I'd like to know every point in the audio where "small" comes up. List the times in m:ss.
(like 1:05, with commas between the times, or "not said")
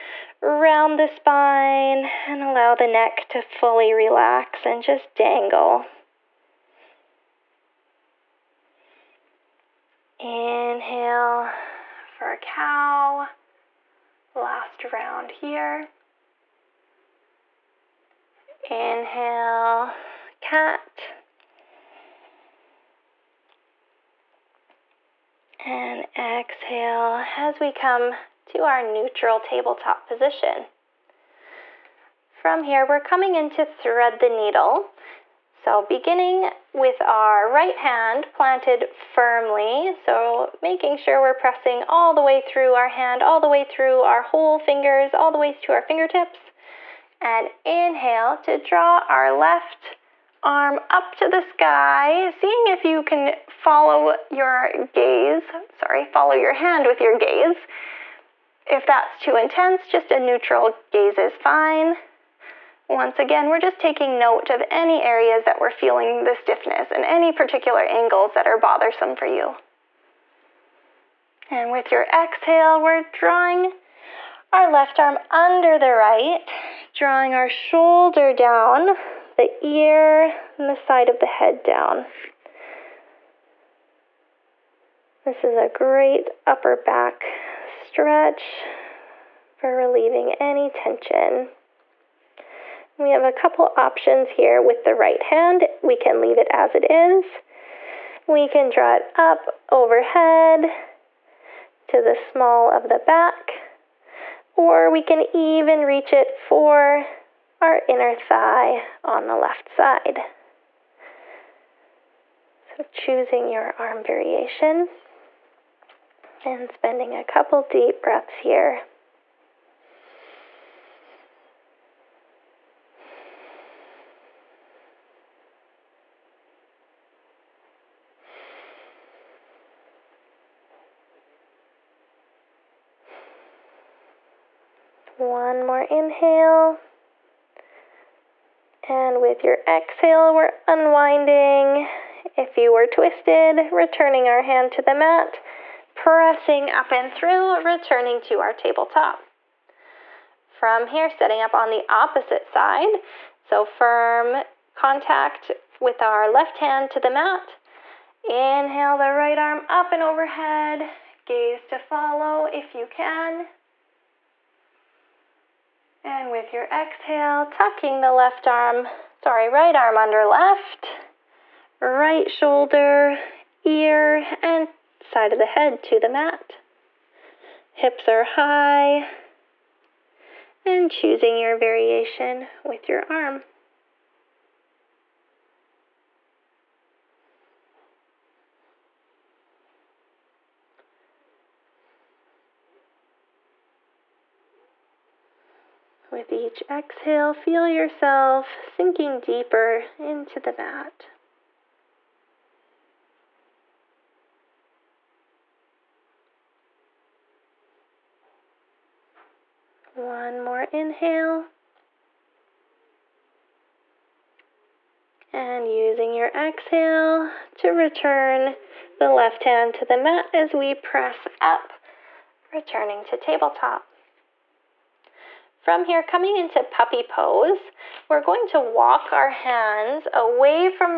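1:42.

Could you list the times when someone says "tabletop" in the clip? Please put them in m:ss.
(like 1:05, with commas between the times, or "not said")
0:29, 2:28, 3:43.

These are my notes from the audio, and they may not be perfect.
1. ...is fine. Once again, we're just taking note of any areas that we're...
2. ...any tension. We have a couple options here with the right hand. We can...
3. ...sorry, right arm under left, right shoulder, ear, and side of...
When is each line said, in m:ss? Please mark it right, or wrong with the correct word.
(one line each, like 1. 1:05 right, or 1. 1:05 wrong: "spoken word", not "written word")
1. 1:01 right
2. 1:30 right
3. 2:49 right.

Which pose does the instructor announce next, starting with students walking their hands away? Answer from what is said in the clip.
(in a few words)
Puppy pose.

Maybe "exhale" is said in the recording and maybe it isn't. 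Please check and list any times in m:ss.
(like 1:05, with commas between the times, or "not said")
0:26, 1:12, 2:19, 2:46, 3:16, 3:36.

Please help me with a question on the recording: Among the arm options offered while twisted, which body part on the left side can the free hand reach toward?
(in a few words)
Inner thigh.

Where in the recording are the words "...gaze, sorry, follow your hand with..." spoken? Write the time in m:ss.
0:54.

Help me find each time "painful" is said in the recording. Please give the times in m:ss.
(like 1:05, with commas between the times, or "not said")
not said.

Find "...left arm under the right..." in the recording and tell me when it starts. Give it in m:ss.
1:14.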